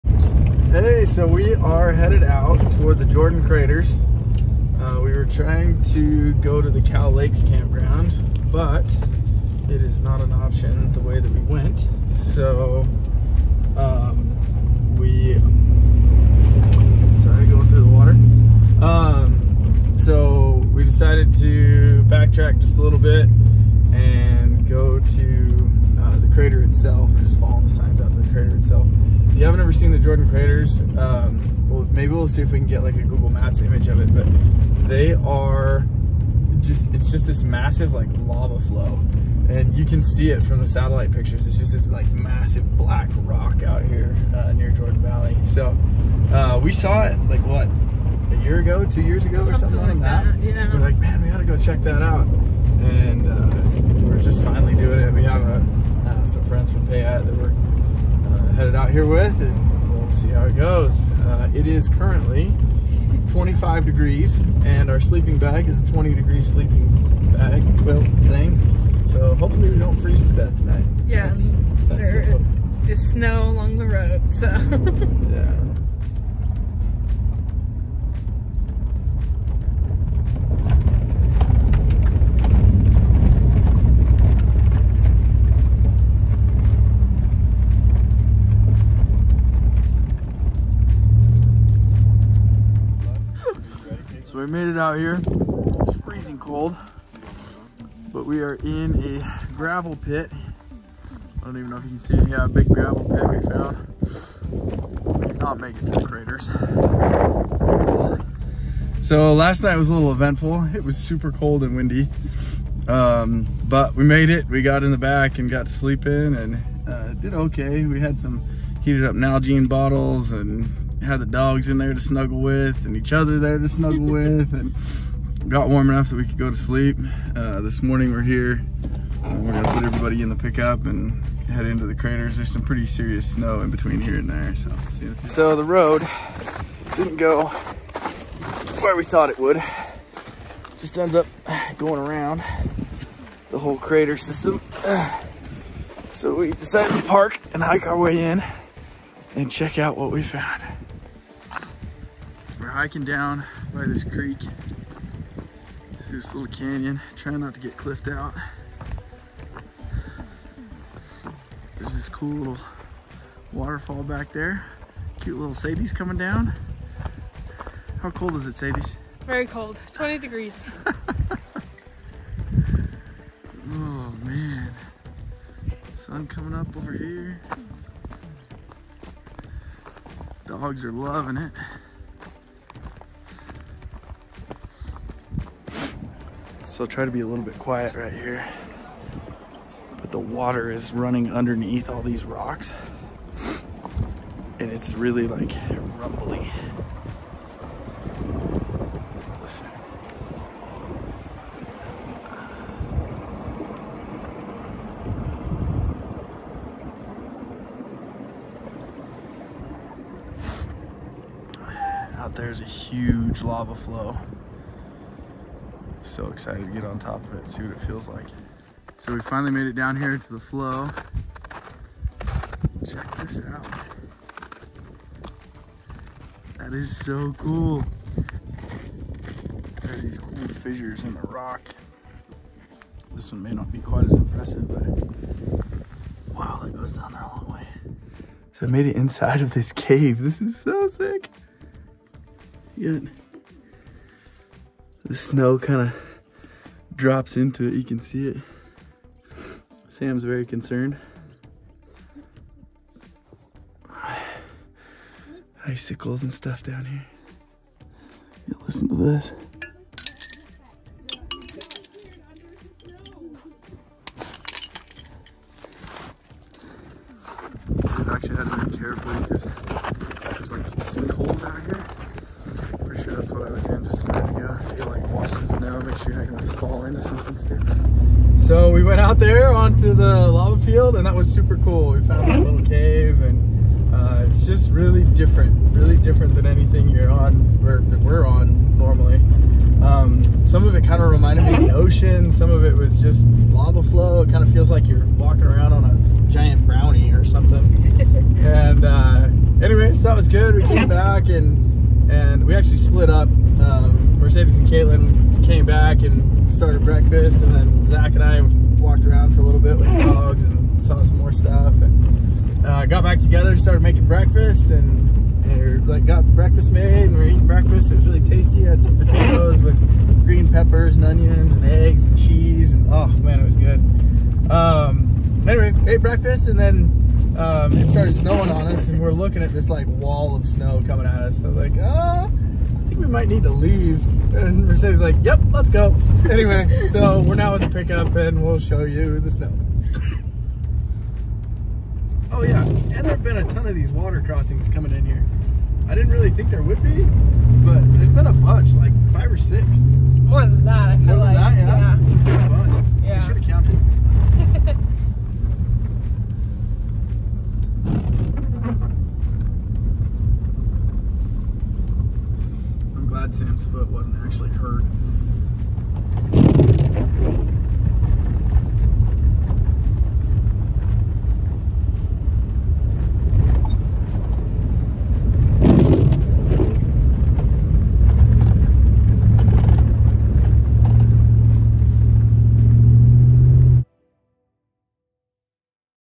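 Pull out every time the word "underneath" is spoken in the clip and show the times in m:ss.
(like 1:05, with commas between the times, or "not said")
3:11.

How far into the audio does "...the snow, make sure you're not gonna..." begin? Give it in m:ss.
4:35.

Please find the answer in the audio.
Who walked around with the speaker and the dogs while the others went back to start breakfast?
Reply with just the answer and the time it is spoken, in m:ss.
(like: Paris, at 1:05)
Zach, at 5:07.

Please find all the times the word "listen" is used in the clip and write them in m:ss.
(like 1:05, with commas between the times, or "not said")
3:19, 4:18.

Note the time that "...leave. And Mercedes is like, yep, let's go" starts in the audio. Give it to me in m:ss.
5:33.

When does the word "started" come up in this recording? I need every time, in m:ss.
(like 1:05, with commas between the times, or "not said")
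5:06, 5:13, 5:27.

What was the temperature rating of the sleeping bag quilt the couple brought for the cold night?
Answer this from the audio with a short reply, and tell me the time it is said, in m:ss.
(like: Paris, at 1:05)
20 degree, at 1:05.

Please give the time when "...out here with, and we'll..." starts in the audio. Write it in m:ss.
0:58.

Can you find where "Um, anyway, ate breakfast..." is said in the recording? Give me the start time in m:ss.
5:24.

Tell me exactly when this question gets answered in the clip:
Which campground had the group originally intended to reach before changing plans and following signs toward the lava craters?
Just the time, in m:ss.
0:06.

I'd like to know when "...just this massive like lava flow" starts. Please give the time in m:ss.
0:37.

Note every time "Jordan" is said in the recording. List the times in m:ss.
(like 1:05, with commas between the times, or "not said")
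0:03, 0:29, 0:44.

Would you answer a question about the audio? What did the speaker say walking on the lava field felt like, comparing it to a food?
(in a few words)
A giant brownie.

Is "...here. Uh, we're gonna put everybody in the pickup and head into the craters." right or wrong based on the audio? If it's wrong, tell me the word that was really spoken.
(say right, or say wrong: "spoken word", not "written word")
right.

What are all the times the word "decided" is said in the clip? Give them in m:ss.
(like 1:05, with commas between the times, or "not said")
0:20, 2:26.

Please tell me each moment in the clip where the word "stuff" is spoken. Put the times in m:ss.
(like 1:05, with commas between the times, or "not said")
4:16, 5:11.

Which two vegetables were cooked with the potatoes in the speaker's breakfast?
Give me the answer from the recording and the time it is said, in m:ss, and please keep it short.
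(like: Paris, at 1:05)
Green peppers and onions, at 5:20.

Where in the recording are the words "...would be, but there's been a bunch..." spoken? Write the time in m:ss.
5:46.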